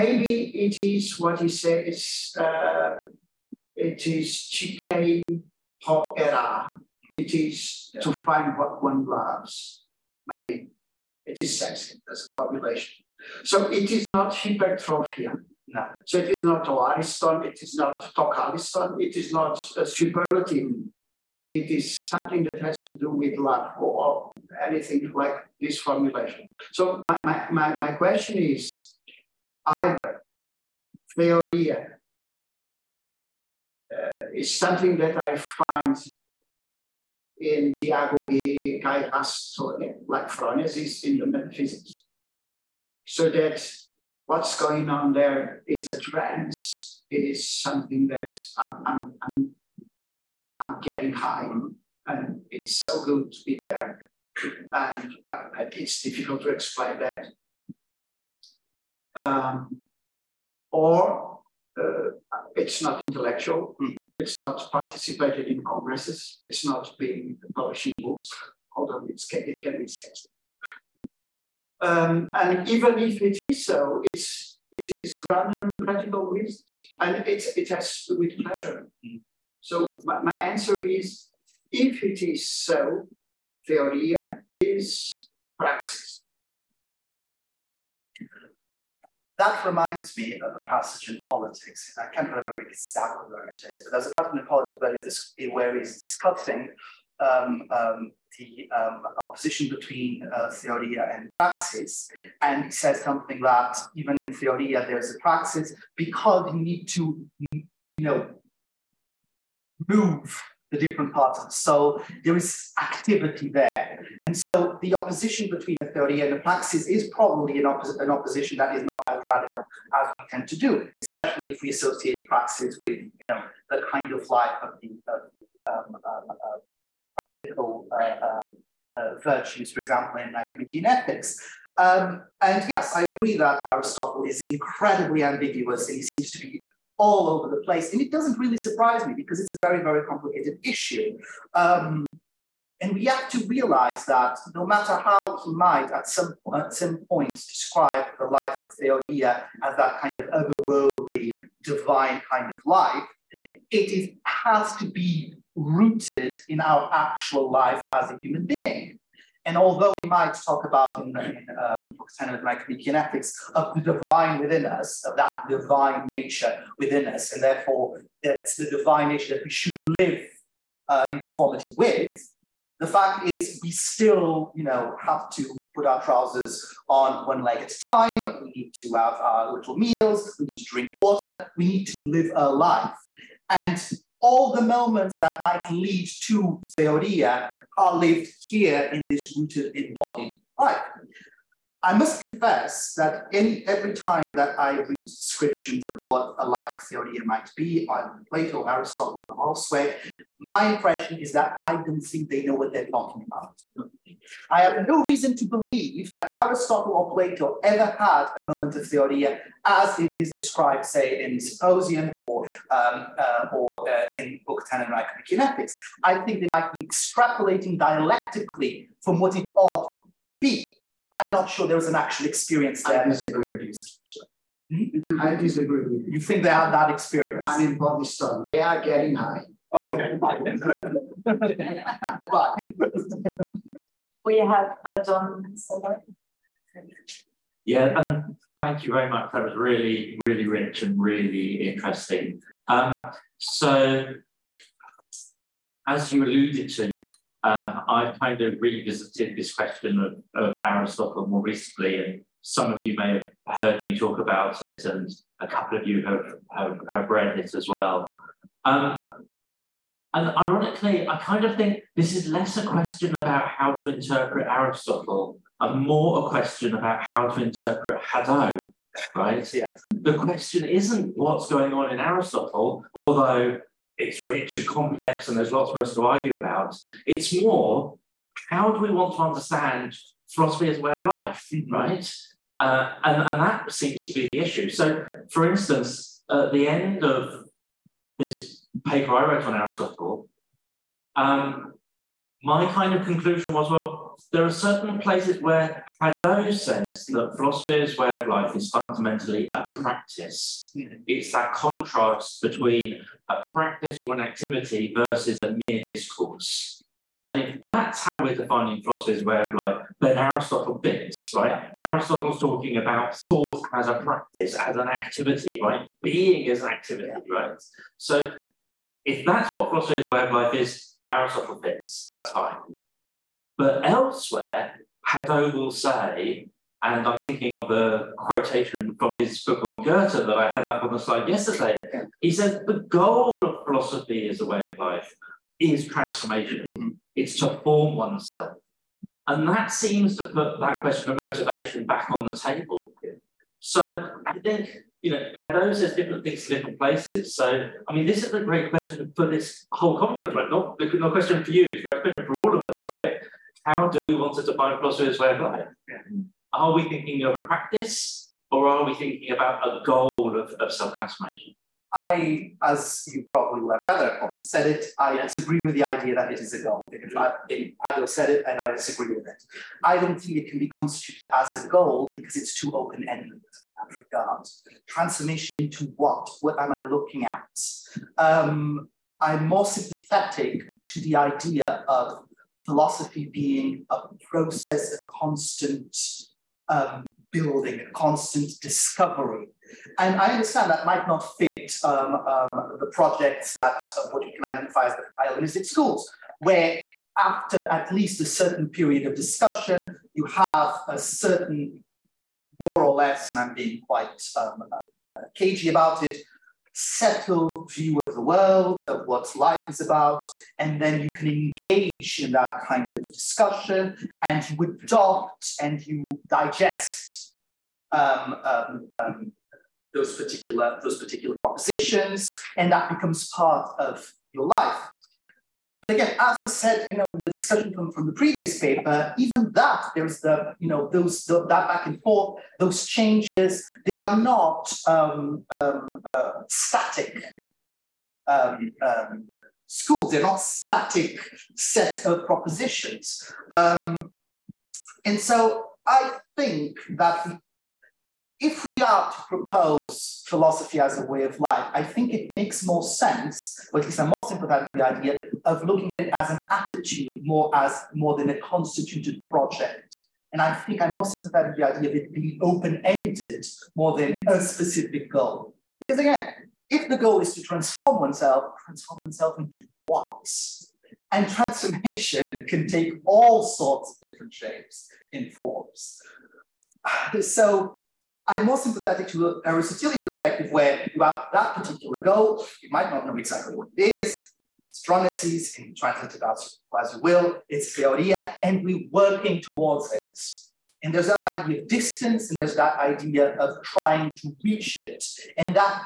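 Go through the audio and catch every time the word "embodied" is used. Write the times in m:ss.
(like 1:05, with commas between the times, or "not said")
3:09.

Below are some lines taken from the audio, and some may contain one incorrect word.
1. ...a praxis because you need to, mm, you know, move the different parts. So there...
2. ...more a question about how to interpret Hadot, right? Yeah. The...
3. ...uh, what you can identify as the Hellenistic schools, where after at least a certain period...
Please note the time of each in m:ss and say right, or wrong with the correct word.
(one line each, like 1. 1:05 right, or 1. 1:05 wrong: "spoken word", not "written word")
1. 1:45 right
2. 4:25 right
3. 6:33 right.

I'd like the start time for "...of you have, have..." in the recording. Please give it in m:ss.
4:15.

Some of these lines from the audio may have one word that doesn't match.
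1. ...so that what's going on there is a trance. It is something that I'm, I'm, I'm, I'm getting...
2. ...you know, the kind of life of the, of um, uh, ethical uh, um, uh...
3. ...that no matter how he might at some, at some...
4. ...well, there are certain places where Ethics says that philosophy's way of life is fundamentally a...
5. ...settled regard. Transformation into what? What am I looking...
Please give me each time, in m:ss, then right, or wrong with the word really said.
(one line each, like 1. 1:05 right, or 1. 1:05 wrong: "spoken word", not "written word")
1. 0:43 right
2. 2:02 right
3. 2:24 right
4. 4:53 wrong: "Hadot", not "Ethics"
5. 6:13 wrong: "ended", not "settled".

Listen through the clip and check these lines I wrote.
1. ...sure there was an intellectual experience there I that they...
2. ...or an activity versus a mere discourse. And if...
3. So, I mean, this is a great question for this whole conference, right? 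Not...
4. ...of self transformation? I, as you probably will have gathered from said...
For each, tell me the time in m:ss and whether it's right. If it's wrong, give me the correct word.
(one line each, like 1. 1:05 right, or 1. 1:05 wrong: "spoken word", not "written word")
1. 3:41 wrong: "actual", not "intellectual"
2. 5:04 right
3. 5:47 right
4. 6:00 right.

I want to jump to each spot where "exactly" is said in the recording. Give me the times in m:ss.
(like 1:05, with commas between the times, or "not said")
1:32, 8:03.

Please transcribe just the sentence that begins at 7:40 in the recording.
And I think I'm more sympathetic to the idea of it being open-ended more than a specific goal.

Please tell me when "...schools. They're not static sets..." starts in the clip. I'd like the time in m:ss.
7:19.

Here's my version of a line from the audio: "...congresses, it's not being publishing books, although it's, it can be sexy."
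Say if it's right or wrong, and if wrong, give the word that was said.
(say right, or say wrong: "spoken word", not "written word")
right.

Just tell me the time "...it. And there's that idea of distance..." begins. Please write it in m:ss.
8:09.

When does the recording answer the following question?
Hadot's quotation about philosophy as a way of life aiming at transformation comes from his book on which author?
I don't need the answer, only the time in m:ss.
5:29.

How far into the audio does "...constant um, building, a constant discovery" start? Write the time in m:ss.
6:25.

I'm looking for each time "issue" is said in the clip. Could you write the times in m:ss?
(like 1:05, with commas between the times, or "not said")
2:20, 4:44.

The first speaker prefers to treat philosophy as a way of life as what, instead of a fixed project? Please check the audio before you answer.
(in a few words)
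An attitude.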